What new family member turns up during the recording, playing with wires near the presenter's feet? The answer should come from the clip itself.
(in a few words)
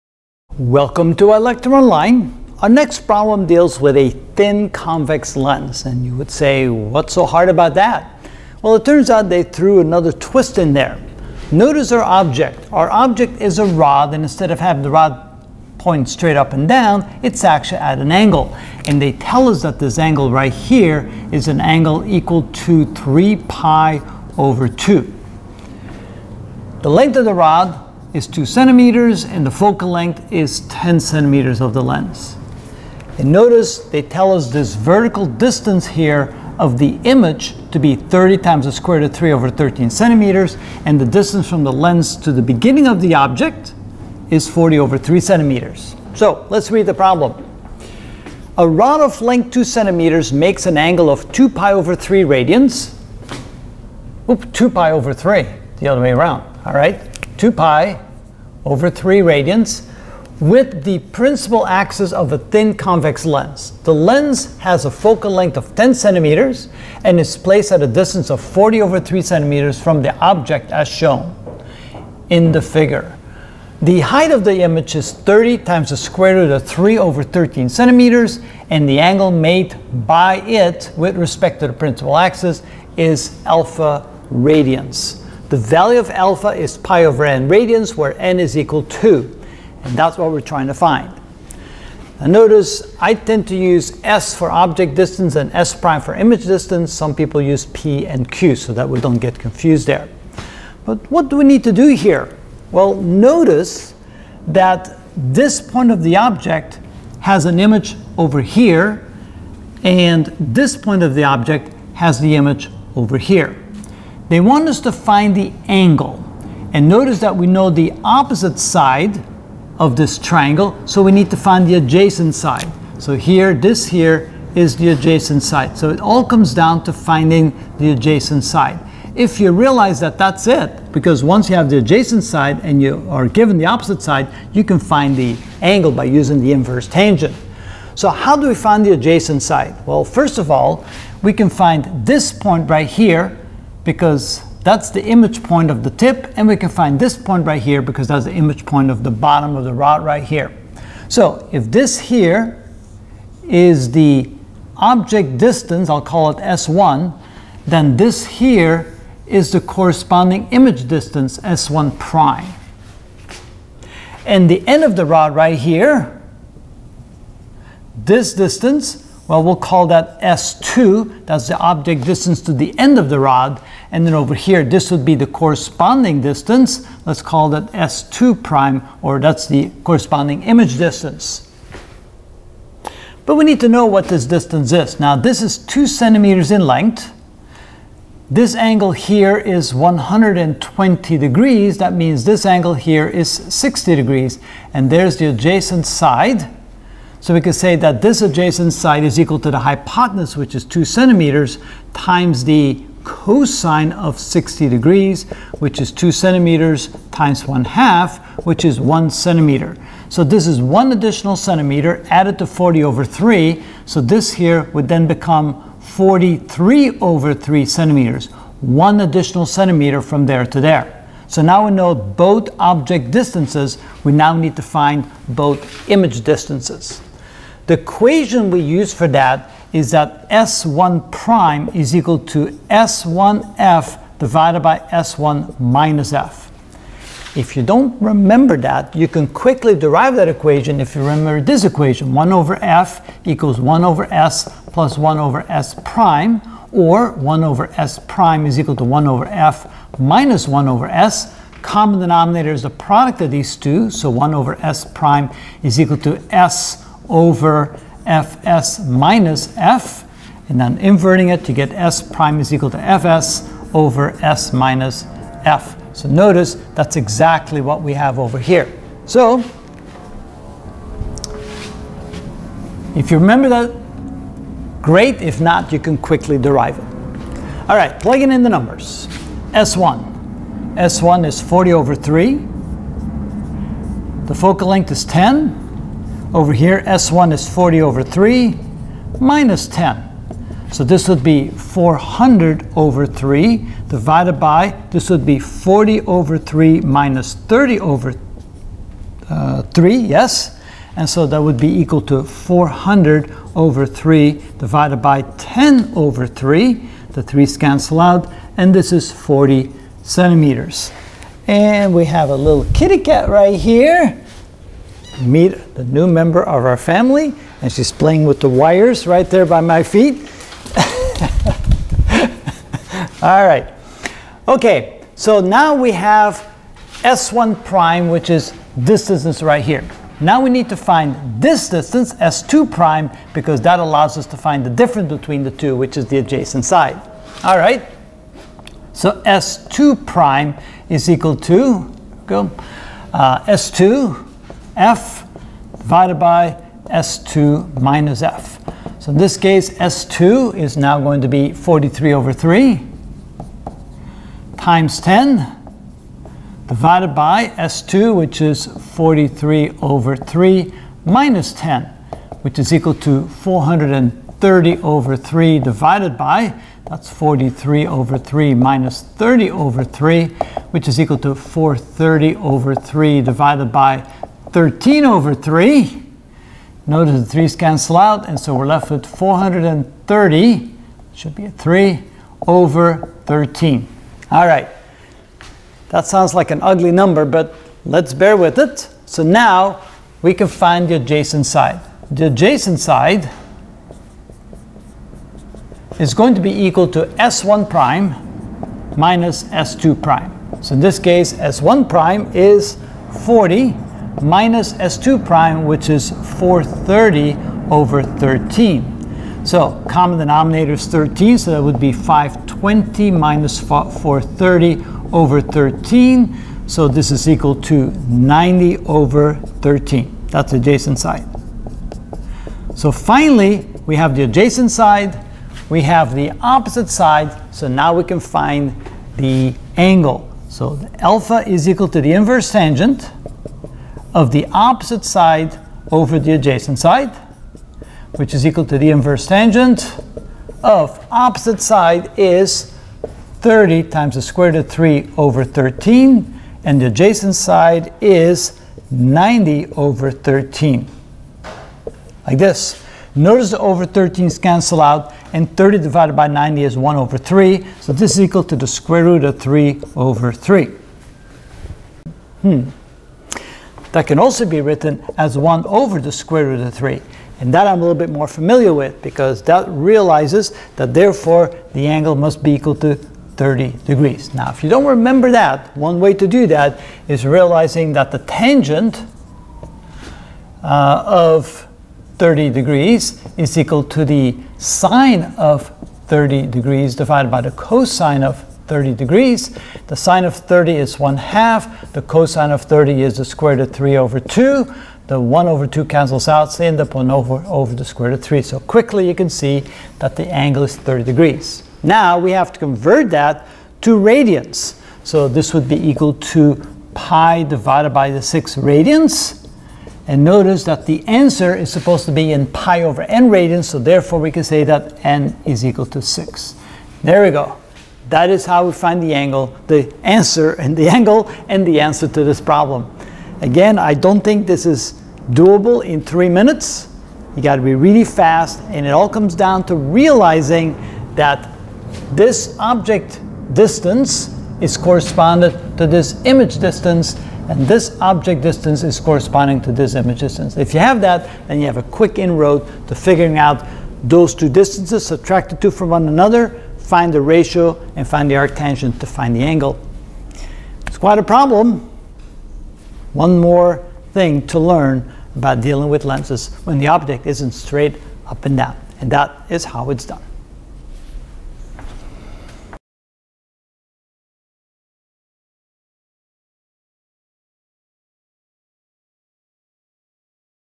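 kitty cat.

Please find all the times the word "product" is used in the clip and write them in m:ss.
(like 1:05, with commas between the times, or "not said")
4:12.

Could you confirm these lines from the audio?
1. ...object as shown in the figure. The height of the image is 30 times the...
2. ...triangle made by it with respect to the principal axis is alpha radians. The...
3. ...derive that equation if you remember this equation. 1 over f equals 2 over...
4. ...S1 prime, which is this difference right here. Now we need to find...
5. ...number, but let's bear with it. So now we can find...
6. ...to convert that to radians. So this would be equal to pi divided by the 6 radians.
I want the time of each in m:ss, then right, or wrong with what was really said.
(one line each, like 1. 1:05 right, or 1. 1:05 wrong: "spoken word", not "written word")
1. 1:10 right
2. 1:18 wrong: "angle", not "triangle"
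3. 3:59 wrong: "1", not "2"
4. 5:27 wrong: "distance", not "difference"
5. 6:26 right
6. 8:22 right.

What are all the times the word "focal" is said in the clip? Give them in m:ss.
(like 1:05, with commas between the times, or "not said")
0:29, 1:04, 4:44.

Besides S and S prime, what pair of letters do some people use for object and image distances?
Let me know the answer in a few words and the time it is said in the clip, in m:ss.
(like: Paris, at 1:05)
P and Q, at 1:37.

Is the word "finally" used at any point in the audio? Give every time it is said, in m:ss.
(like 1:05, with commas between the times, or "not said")
7:02.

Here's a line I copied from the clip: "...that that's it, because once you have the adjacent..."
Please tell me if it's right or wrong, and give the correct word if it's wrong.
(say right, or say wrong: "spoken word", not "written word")
right.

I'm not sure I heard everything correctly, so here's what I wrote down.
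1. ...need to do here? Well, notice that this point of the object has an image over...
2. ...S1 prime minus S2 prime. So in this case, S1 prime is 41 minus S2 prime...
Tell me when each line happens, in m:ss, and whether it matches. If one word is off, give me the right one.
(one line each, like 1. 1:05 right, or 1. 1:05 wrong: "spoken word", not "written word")
1. 1:41 right
2. 6:37 wrong: "40", not "41".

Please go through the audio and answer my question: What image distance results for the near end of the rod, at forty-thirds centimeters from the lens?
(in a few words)
40 centimeters.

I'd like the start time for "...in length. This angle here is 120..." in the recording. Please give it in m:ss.
3:06.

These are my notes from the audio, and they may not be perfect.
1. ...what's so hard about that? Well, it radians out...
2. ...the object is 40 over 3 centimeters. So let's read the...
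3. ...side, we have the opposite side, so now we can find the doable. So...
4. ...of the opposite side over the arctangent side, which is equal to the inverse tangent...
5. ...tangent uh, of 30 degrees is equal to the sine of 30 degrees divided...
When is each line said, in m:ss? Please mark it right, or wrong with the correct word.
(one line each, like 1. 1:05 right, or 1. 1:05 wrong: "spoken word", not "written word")
1. 0:06 wrong: "turns", not "radians"
2. 0:43 right
3. 7:04 wrong: "angle", not "doable"
4. 7:14 wrong: "adjacent", not "arctangent"
5. 7:58 right.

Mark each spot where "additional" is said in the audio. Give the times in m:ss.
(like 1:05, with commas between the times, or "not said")
3:30, 3:38.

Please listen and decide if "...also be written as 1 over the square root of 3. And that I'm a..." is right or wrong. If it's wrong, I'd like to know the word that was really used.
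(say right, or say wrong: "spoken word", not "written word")
right.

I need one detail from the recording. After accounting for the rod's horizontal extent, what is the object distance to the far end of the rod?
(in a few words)
43/3 centimeters.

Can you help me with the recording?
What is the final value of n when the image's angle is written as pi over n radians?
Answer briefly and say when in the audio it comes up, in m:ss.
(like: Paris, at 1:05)
6, at 8:35.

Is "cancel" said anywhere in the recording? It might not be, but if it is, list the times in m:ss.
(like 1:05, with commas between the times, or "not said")
5:07, 6:17, 7:34, 8:15.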